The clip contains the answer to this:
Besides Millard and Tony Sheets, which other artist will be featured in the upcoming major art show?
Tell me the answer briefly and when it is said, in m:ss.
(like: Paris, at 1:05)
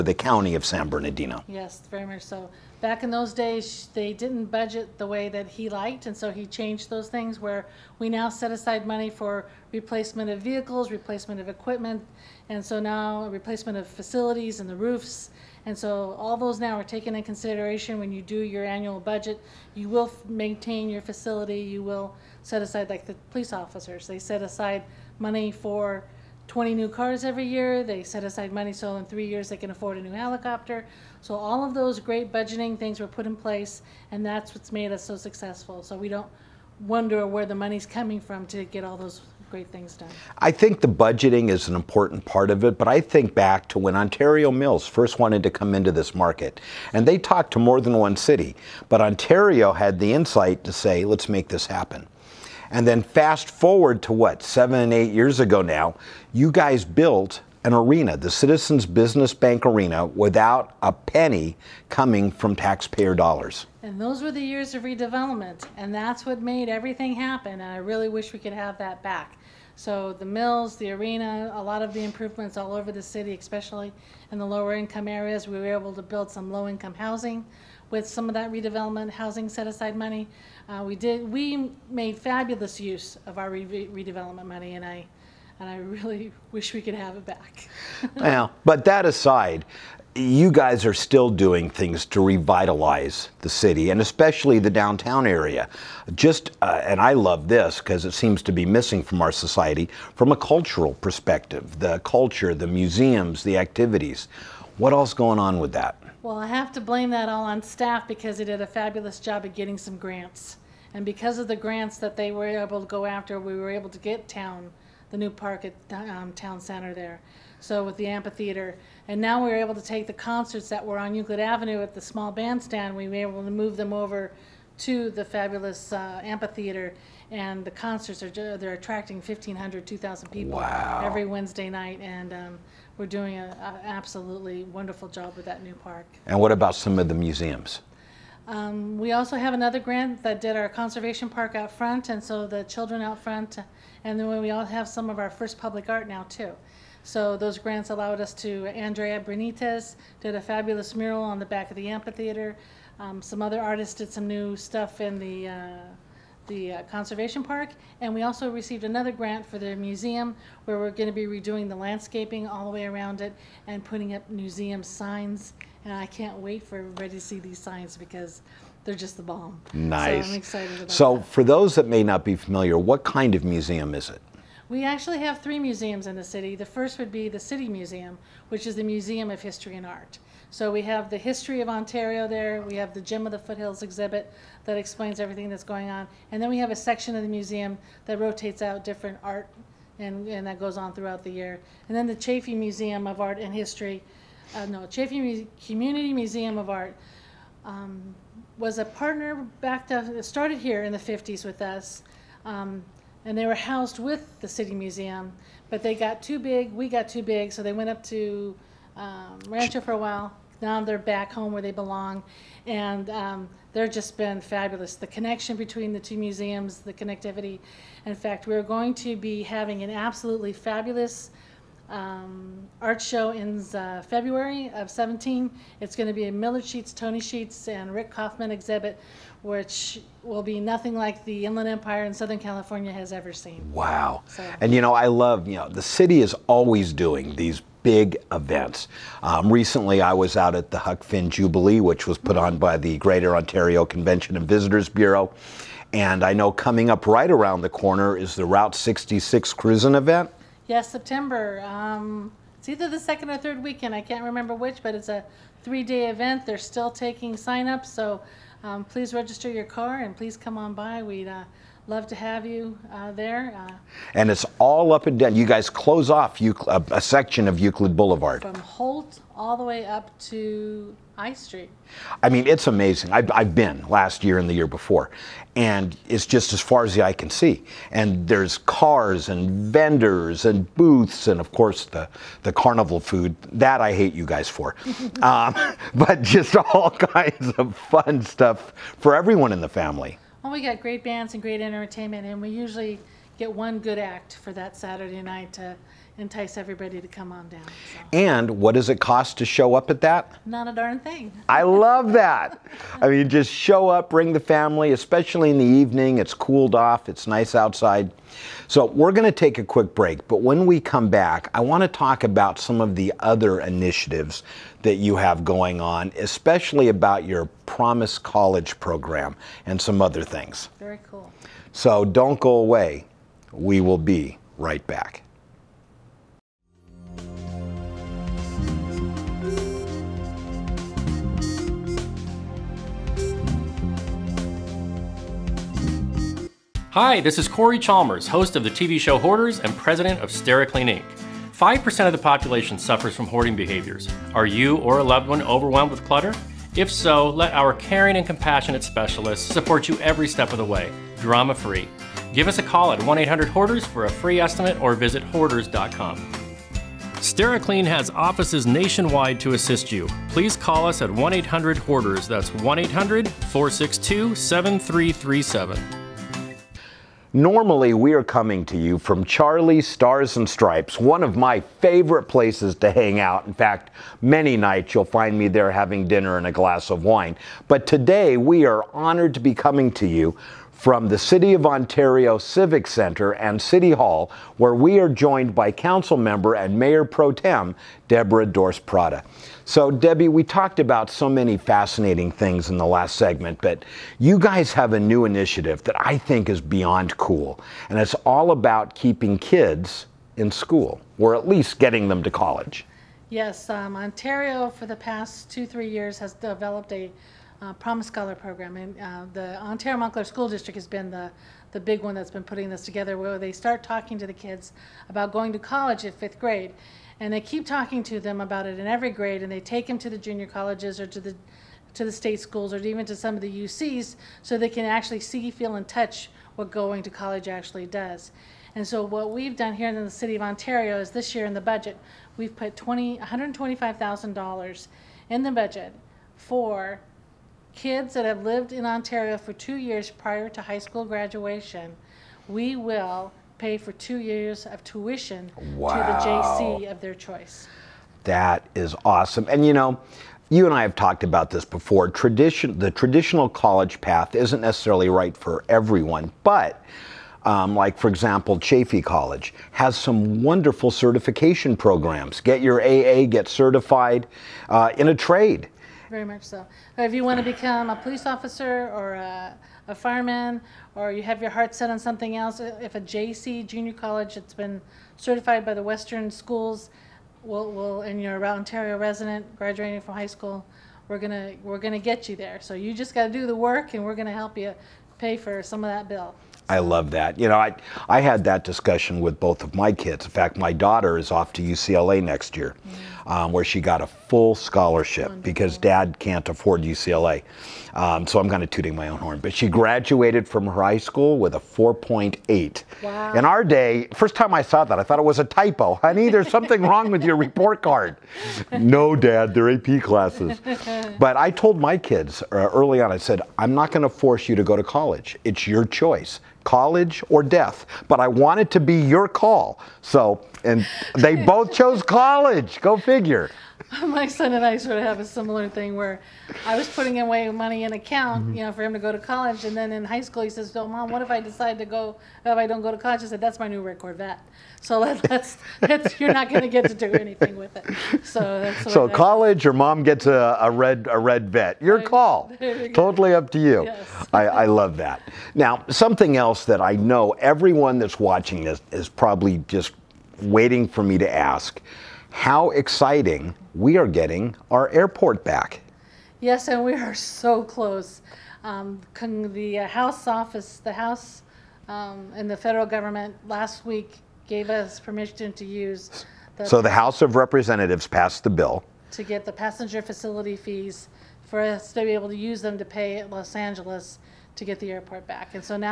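Rick Kaufman, at 3:47.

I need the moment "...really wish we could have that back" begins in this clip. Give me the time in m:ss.
1:07.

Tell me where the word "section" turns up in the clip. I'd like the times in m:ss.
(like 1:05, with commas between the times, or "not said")
3:06, 4:27.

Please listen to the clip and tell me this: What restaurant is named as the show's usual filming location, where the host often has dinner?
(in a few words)
Charlie's Stars and Stripes.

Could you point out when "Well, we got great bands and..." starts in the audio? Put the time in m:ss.
4:50.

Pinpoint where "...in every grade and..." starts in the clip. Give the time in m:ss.
6:58.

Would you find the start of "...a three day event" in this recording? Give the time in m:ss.
4:15.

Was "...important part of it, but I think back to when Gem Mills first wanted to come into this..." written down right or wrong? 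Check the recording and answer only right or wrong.
wrong.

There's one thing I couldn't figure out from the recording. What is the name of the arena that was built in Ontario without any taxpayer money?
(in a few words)
Citizens Business Bank Arena.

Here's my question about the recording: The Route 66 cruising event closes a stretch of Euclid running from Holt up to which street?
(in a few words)
High Street.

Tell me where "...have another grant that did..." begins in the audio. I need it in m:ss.
2:19.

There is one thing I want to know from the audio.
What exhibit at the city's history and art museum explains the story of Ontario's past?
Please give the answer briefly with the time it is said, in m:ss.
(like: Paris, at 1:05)
Gem of the Foothills, at 3:03.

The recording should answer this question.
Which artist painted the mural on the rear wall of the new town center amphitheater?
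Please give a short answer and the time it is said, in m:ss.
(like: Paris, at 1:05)
Andrea Benitez, at 2:28.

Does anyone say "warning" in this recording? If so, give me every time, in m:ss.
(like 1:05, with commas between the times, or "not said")
not said.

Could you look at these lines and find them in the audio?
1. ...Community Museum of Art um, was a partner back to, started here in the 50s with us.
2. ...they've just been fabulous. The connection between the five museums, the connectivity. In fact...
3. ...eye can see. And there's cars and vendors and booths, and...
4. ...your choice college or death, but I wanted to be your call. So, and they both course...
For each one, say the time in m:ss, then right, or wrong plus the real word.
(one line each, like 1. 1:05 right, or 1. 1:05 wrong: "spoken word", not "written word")
1. 3:15 right
2. 3:33 wrong: "two", not "five"
3. 4:37 right
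4. 8:35 wrong: "chose", not "course".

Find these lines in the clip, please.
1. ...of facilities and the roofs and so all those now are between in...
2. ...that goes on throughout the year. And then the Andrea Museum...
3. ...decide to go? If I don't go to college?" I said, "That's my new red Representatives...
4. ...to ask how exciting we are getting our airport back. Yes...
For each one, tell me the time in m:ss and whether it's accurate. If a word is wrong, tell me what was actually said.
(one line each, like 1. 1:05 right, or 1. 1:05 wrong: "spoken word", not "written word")
1. 0:13 wrong: "taken", not "between"
2. 3:10 wrong: "Chaffey", not "Andrea"
3. 8:51 wrong: "Corvette", not "Representatives"
4. 9:11 right.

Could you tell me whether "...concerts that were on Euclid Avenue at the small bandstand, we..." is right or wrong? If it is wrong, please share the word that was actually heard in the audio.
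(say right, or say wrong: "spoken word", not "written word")
right.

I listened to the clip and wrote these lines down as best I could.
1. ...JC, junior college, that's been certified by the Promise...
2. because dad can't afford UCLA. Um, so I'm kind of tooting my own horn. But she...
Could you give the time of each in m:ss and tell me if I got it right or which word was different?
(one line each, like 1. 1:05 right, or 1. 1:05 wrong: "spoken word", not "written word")
1. 7:53 wrong: "Western", not "Promise"
2. 8:15 right.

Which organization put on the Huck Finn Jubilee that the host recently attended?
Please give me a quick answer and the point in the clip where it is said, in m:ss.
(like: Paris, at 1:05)
Greater Ontario Convention and Visitors Bureau, at 4:02.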